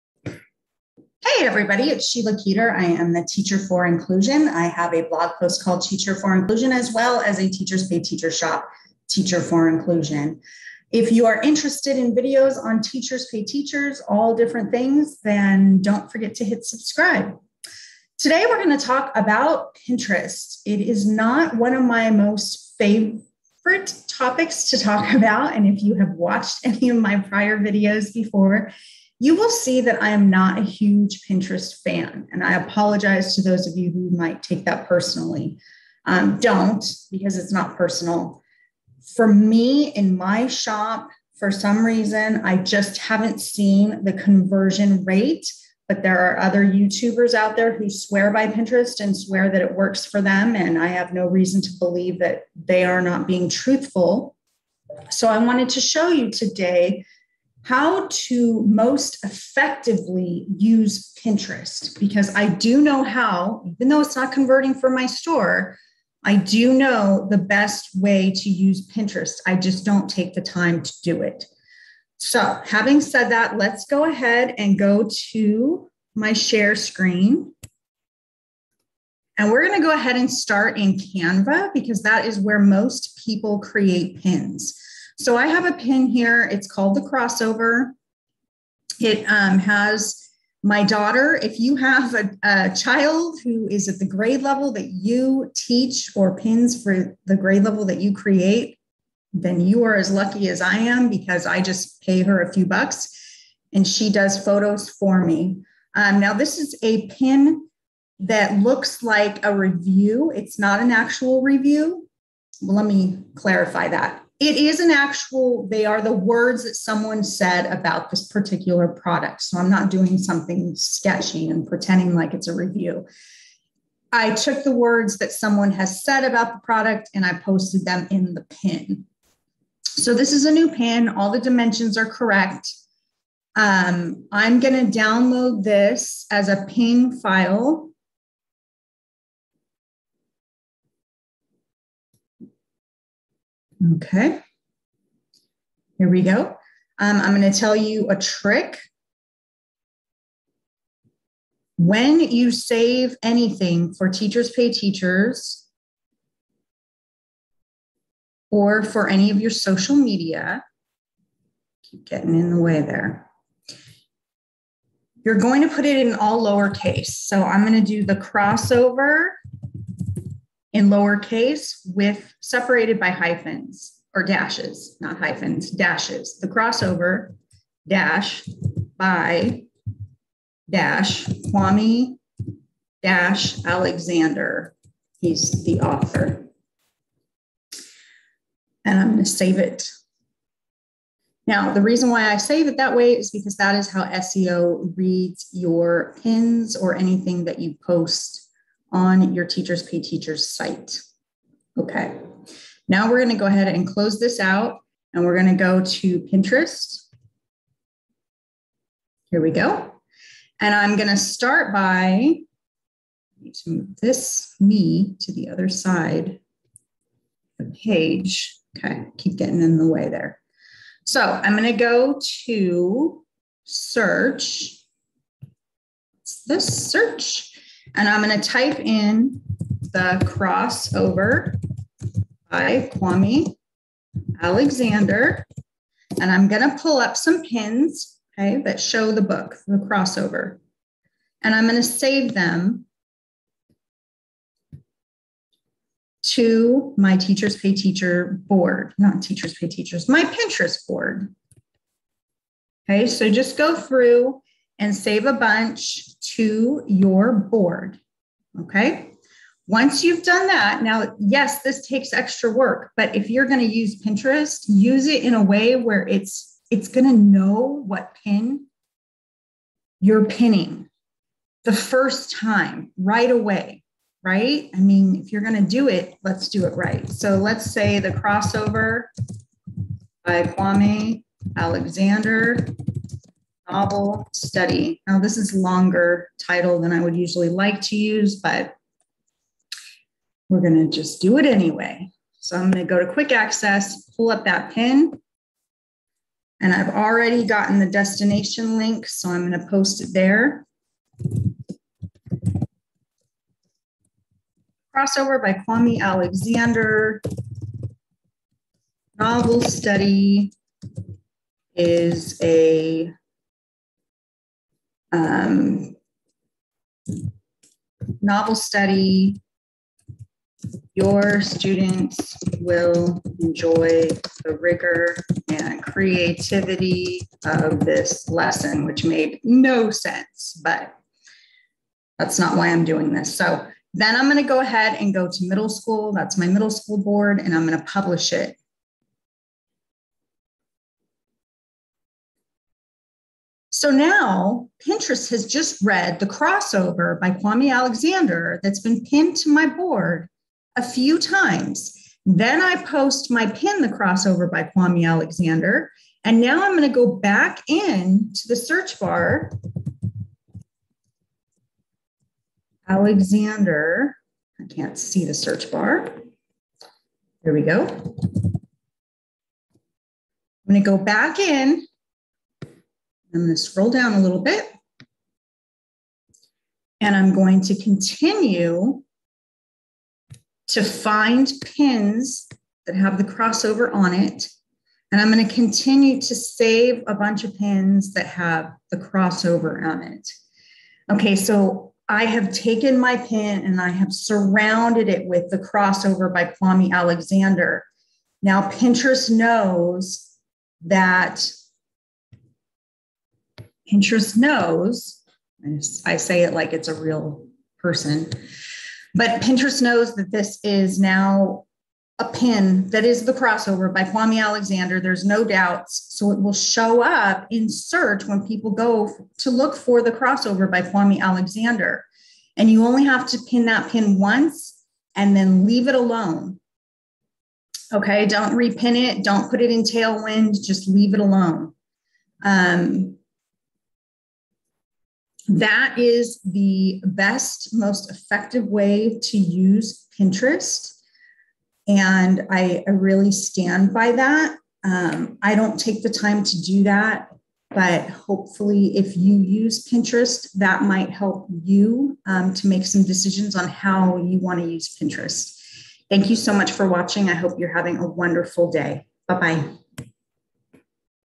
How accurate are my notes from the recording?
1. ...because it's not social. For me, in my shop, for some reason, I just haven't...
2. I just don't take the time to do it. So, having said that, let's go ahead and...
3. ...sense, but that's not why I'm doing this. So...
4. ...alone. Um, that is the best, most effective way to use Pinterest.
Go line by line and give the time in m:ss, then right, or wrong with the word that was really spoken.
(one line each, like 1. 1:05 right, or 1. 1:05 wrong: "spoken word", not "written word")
1. 0:37 wrong: "personal", not "social"
2. 1:09 right
3. 5:29 right
4. 7:11 right.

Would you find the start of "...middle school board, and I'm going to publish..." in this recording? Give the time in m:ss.
5:36.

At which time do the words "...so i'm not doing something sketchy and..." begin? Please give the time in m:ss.
1:59.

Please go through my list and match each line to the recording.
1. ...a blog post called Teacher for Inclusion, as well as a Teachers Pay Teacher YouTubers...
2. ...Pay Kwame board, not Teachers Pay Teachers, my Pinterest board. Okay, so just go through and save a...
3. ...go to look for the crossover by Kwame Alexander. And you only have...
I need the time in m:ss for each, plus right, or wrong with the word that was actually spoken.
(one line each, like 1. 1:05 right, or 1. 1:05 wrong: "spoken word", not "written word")
1. 0:04 wrong: "Shop", not "YouTubers"
2. 4:07 wrong: "Teacher", not "Kwame"
3. 6:58 right.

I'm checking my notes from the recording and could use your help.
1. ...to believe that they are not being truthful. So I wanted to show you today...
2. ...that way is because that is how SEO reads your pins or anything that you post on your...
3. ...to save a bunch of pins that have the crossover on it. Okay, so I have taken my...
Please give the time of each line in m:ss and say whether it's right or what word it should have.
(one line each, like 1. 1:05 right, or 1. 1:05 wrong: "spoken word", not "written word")
1. 0:51 right
2. 3:12 right
3. 6:26 right.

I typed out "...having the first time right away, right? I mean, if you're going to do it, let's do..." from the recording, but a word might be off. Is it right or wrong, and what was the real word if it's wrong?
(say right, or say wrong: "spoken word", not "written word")
wrong: "pinning", not "having".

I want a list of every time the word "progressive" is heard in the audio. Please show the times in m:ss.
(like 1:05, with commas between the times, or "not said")
not said.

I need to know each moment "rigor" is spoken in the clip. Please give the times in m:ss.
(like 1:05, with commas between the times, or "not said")
5:24.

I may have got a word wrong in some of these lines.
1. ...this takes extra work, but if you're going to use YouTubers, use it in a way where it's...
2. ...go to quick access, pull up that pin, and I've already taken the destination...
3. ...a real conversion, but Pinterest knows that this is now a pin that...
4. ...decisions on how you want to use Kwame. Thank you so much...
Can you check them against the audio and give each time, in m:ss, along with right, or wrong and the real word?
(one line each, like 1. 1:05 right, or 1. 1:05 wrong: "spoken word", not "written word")
1. 4:21 wrong: "Pinterest", not "YouTubers"
2. 4:52 wrong: "gotten", not "taken"
3. 6:46 wrong: "person", not "conversion"
4. 7:33 wrong: "Pinterest", not "Kwame".